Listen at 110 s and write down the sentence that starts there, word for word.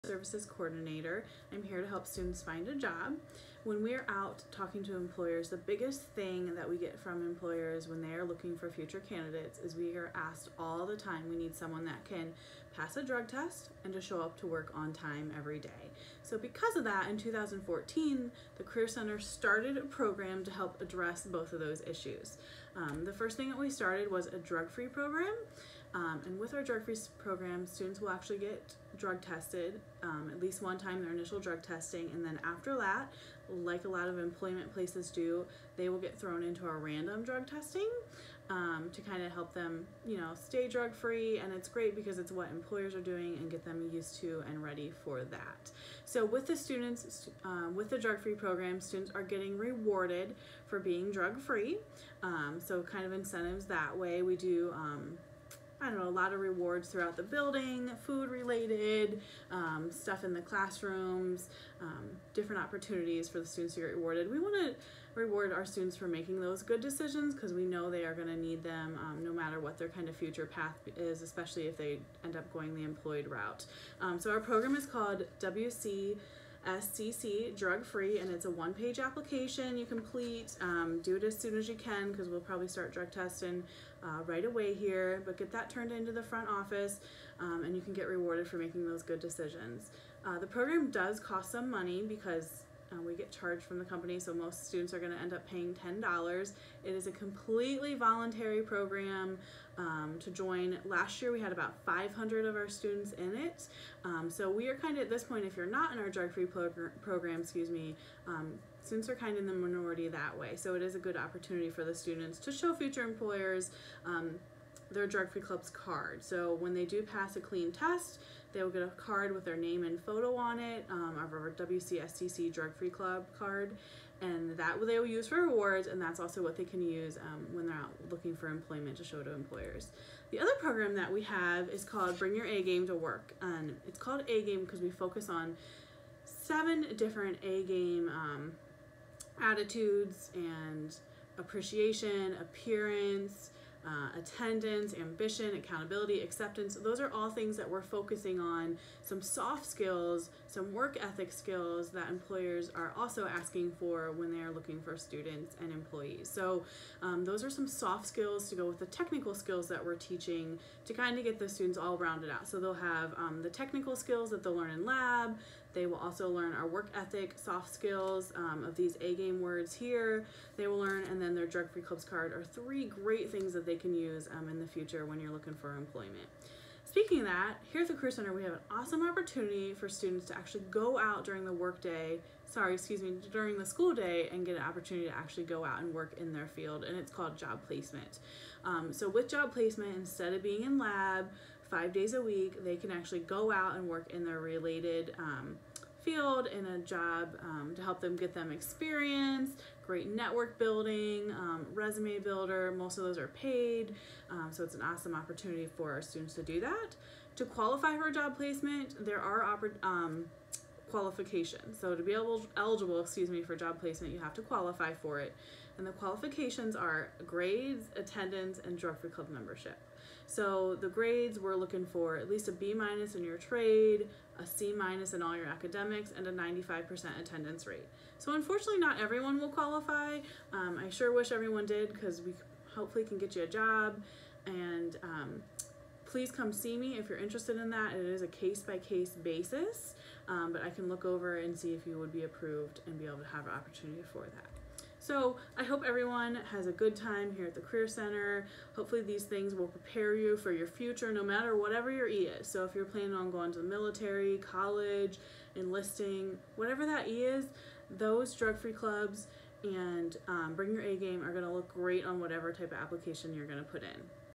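So it is a good opportunity for the students to show future employers um, their Drug Free Club's card.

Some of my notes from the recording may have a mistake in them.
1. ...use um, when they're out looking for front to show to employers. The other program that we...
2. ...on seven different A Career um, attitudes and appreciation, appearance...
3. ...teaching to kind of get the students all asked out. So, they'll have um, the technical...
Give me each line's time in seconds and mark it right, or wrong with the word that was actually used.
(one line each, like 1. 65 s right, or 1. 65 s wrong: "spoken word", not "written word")
1. 126 s wrong: "employment", not "front"
2. 135 s wrong: "Game", not "Career"
3. 159 s wrong: "rounded", not "asked".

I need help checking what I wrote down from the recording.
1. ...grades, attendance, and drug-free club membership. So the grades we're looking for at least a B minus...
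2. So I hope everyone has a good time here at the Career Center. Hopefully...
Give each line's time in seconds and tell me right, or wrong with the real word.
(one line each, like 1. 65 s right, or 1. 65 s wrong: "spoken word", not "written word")
1. 217 s right
2. 244 s right.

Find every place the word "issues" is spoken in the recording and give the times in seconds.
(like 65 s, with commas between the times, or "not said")
21 s.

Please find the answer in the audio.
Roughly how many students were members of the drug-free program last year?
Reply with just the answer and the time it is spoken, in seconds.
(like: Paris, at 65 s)
500, at 101 s.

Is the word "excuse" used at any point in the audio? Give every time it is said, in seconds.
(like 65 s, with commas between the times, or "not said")
107 s, 182 s, 213 s.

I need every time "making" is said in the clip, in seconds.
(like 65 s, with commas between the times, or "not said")
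66 s, 88 s.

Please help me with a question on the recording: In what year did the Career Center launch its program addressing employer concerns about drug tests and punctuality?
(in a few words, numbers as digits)
2014.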